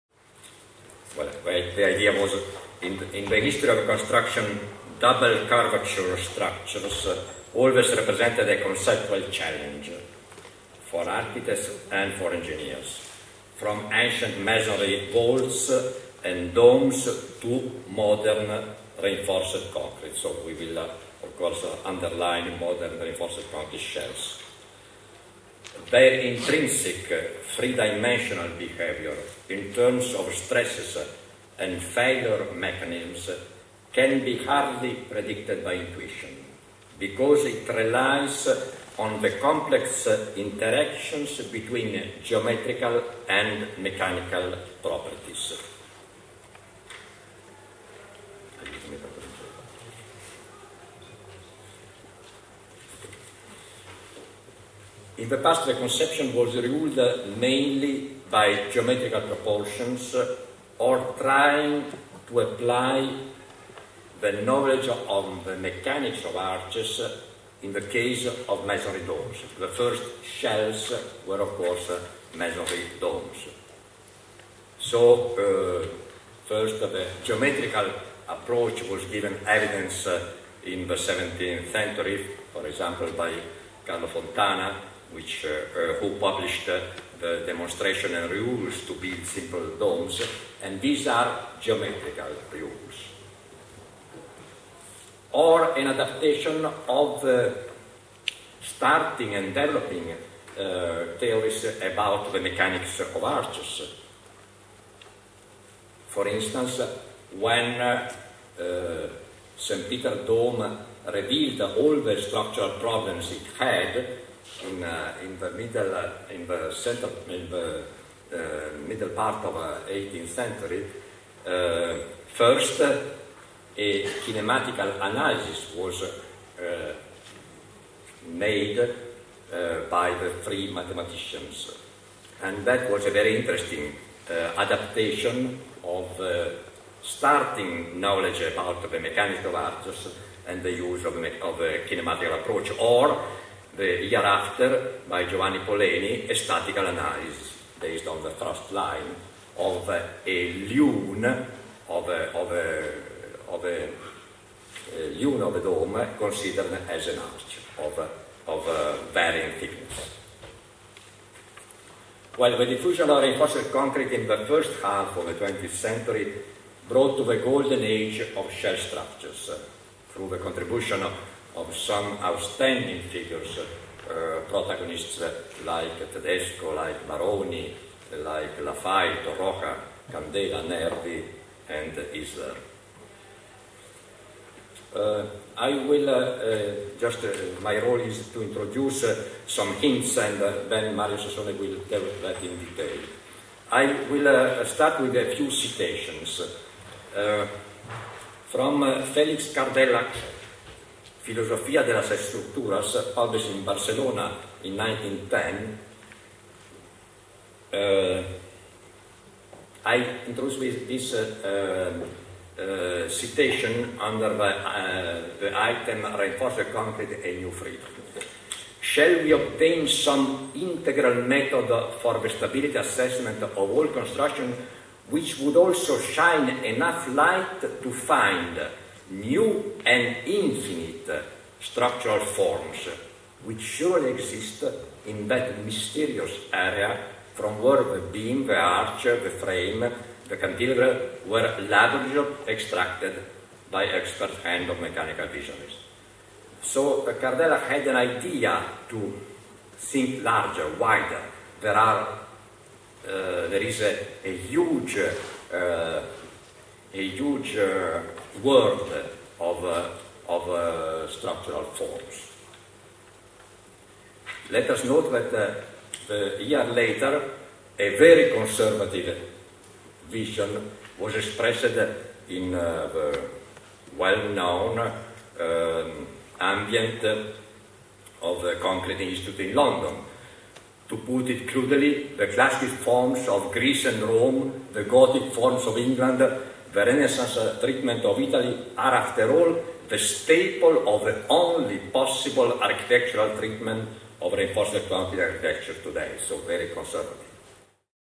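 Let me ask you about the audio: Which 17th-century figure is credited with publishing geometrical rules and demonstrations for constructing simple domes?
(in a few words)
Carlo Fontana.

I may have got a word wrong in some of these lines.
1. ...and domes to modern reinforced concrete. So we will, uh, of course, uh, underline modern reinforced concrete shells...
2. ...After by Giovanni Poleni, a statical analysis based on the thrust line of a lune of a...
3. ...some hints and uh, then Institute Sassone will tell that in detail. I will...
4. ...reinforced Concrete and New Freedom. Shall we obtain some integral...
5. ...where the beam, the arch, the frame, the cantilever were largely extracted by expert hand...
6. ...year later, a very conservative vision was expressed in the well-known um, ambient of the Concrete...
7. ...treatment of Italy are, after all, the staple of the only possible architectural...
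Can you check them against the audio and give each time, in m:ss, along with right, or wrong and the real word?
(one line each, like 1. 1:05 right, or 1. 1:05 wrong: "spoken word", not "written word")
1. 0:16 right
2. 2:24 right
3. 3:09 wrong: "Mario", not "Institute"
4. 3:36 right
5. 3:57 right
6. 4:26 right
7. 4:47 right.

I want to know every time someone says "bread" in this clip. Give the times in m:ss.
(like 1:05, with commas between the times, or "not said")
not said.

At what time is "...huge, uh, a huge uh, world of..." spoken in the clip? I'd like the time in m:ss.
4:14.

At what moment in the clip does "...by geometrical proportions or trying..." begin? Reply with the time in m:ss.
0:58.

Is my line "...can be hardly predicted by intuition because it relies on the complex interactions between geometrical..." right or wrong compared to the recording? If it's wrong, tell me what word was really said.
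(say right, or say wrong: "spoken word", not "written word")
right.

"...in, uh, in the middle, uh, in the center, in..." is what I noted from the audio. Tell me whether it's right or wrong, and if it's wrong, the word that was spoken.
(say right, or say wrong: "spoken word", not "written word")
right.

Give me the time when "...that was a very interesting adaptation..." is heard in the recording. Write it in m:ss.
2:12.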